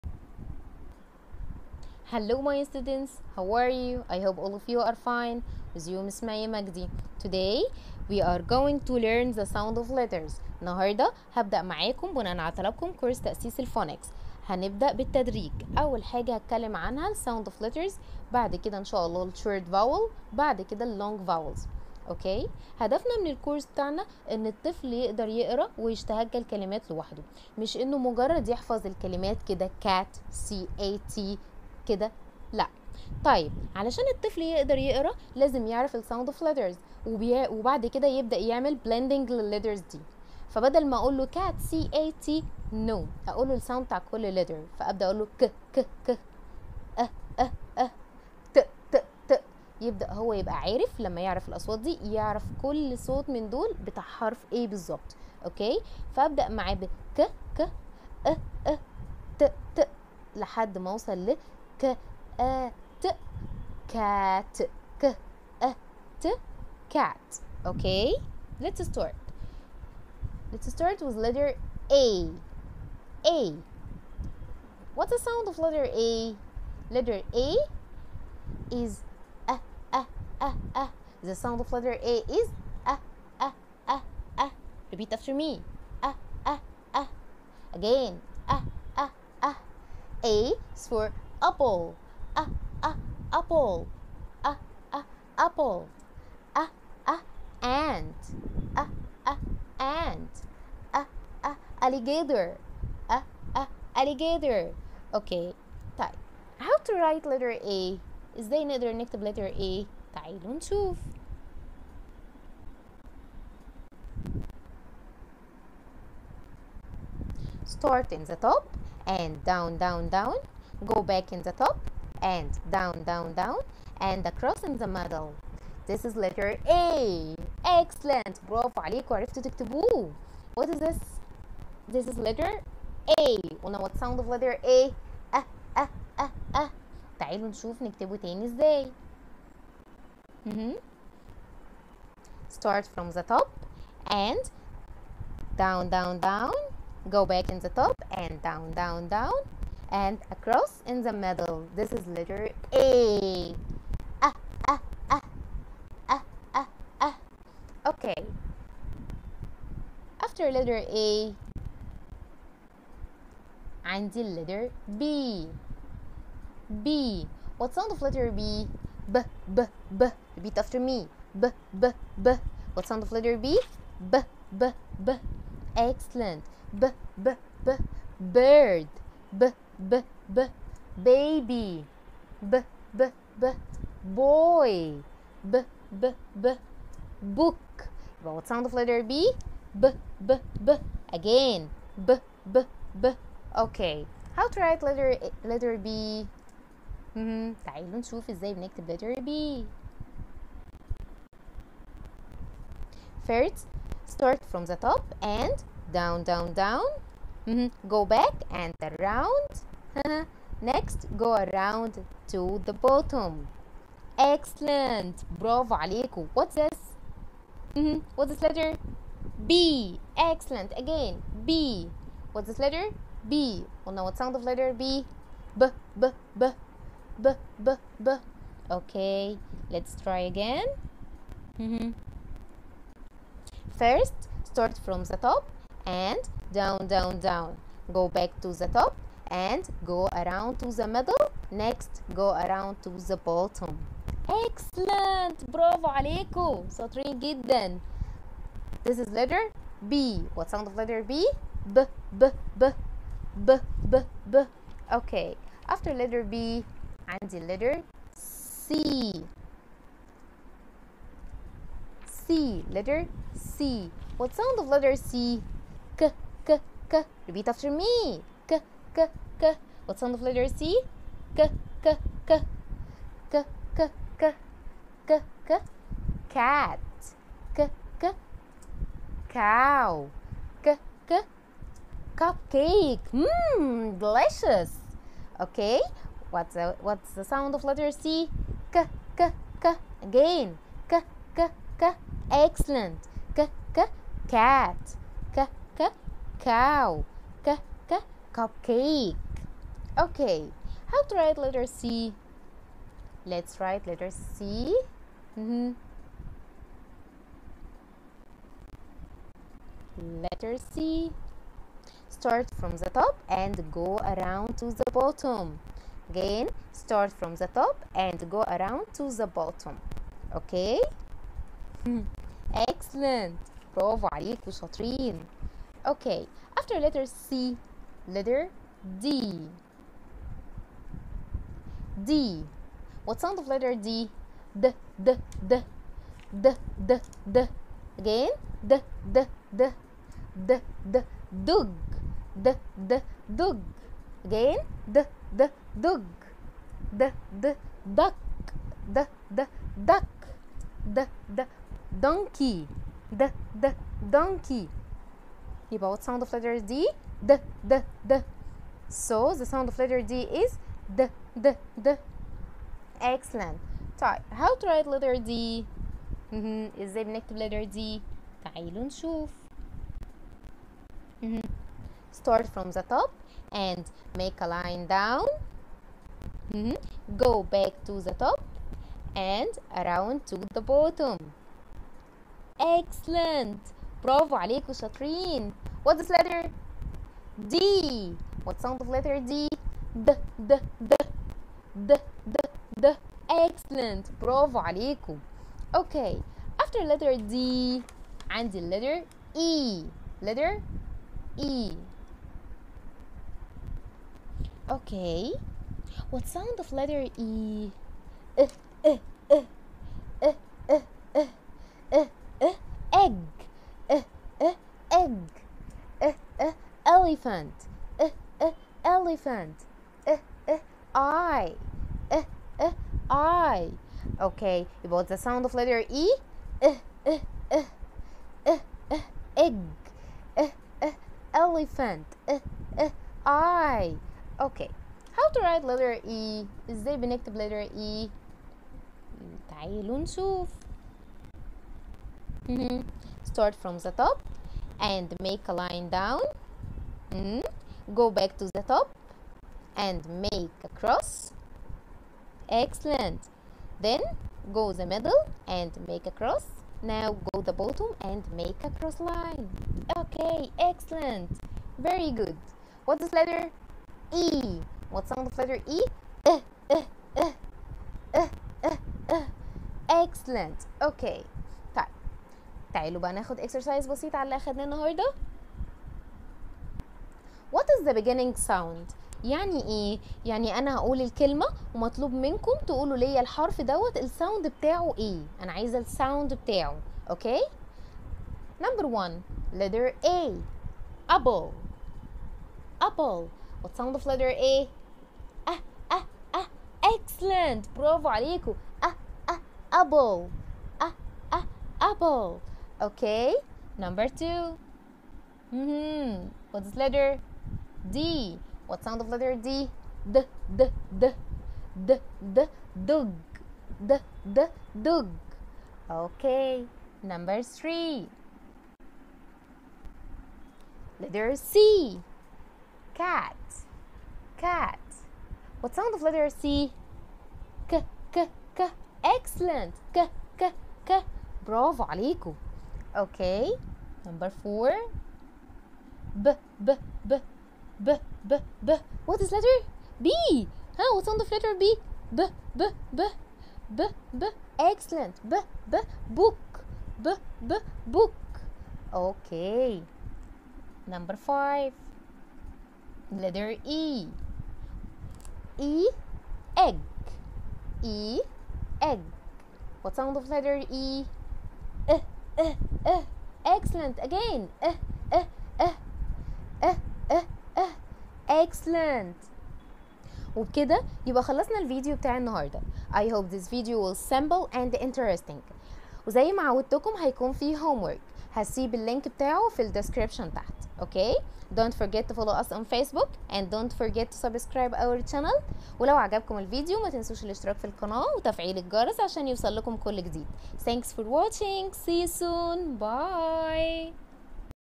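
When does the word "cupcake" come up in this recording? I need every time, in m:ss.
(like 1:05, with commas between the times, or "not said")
4:42, 4:58.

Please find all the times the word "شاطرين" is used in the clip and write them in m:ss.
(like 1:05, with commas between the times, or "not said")
5:24, 6:24.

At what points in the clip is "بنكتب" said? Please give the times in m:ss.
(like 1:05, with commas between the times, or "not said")
3:18, 6:07, 7:16.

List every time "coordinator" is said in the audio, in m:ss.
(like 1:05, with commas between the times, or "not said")
not said.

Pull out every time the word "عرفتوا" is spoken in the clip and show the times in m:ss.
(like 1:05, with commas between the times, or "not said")
2:09.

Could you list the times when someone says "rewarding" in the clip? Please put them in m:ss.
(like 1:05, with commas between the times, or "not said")
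not said.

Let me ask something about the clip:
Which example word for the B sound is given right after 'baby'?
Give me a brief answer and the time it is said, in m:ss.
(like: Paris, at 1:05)
Boy, at 3:02.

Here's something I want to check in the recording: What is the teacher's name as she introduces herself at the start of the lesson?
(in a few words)
Miss مايا مجدي.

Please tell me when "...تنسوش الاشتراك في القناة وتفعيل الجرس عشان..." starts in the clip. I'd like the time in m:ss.
9:46.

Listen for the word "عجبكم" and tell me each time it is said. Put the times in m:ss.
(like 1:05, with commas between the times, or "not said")
9:45.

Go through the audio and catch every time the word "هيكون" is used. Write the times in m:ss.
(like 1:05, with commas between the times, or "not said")
9:36.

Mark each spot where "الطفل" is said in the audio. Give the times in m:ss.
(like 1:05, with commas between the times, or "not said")
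0:24, 0:34.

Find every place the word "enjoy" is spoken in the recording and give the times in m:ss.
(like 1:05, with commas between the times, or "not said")
not said.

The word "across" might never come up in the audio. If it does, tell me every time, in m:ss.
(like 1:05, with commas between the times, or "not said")
2:04, 2:30.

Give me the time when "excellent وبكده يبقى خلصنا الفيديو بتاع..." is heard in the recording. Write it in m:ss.
9:28.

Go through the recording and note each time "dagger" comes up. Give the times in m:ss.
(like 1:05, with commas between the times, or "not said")
not said.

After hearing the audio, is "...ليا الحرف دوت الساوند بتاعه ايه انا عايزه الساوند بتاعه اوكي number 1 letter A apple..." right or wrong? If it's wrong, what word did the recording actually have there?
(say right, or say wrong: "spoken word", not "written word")
right.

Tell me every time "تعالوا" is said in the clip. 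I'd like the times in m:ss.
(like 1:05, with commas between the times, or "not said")
1:50, 2:17, 3:17, 6:08, 7:19, 7:52.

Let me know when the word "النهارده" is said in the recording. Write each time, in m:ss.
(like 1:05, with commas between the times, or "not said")
0:10, 7:54, 9:32.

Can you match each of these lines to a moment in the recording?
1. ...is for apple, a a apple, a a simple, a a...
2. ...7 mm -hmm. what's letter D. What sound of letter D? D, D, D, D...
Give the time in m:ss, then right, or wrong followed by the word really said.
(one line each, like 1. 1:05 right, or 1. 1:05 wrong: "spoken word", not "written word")
1. 1:30 wrong: "apple", not "simple"
2. 8:24 wrong: "2", not "7".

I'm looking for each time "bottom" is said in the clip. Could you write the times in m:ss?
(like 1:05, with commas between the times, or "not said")
3:32, 4:03, 5:14, 5:19, 6:20, 7:37.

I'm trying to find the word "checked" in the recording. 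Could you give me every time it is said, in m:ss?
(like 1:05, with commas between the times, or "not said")
not said.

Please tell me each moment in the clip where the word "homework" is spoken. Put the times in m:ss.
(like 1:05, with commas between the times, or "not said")
9:37.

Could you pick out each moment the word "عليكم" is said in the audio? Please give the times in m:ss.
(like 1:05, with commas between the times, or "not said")
2:08, 3:35, 4:05, 5:24, 6:24, 6:34, 8:18, 8:51.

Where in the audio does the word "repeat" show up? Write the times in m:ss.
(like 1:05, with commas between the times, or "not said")
1:24, 2:50, 4:27.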